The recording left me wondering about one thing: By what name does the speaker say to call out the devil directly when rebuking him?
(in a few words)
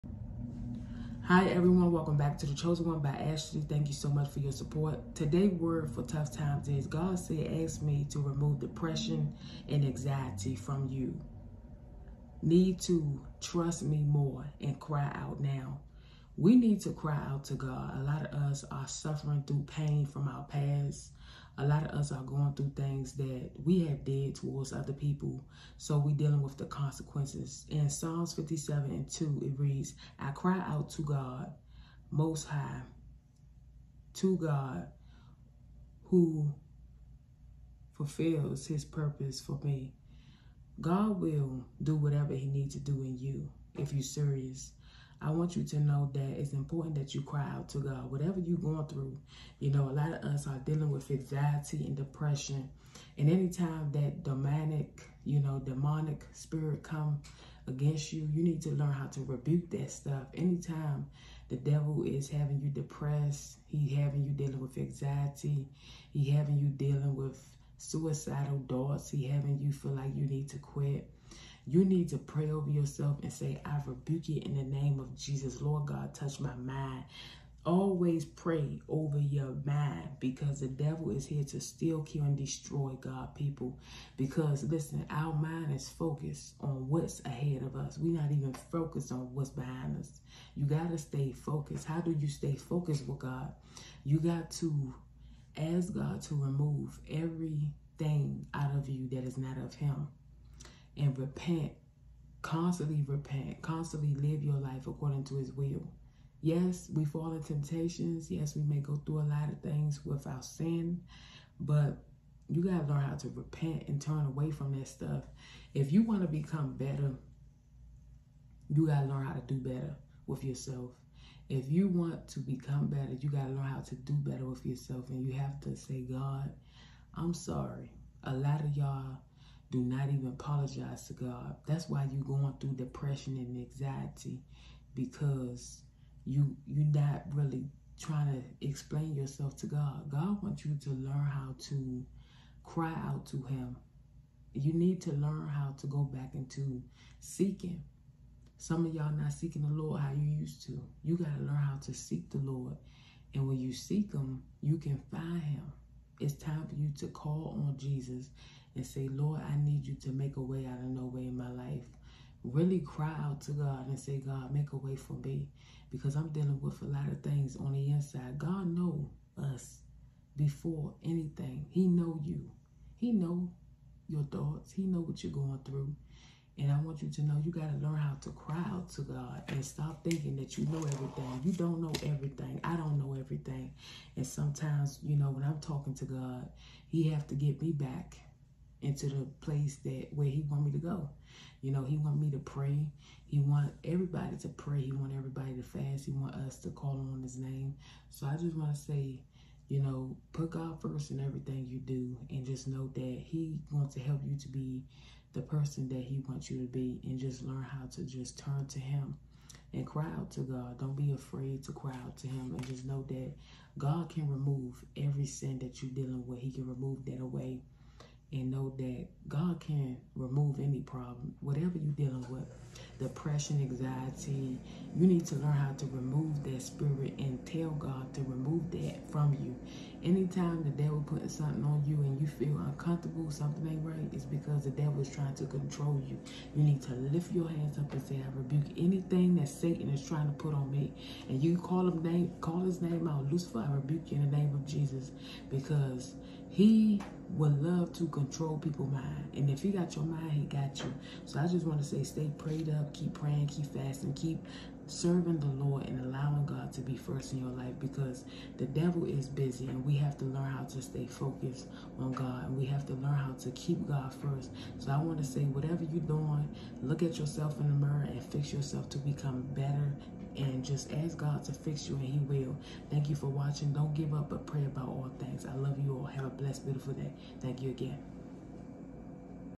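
Lucifer.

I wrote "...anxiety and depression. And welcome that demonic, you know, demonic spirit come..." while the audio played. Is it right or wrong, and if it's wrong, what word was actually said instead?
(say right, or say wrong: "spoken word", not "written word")
wrong: "anytime", not "welcome".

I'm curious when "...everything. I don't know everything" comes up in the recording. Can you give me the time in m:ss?
3:02.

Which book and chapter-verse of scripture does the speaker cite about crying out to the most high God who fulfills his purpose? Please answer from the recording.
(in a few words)
Psalms 57:2.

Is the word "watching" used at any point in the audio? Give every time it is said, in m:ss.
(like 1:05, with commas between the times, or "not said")
4:33.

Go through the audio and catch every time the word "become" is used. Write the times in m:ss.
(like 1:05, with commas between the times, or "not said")
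1:56, 2:02, 4:28.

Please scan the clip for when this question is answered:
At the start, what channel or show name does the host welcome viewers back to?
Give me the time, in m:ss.
0:02.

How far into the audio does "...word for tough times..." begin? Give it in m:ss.
0:05.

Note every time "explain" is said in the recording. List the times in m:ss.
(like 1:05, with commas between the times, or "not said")
2:18.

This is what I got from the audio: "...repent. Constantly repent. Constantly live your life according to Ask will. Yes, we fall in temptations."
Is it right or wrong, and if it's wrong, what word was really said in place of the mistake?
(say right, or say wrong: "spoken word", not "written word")
wrong: "His", not "Ask".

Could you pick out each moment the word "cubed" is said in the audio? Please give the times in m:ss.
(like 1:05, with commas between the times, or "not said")
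not said.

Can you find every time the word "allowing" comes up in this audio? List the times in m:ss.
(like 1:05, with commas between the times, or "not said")
4:16.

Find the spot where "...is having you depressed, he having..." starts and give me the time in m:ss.
1:02.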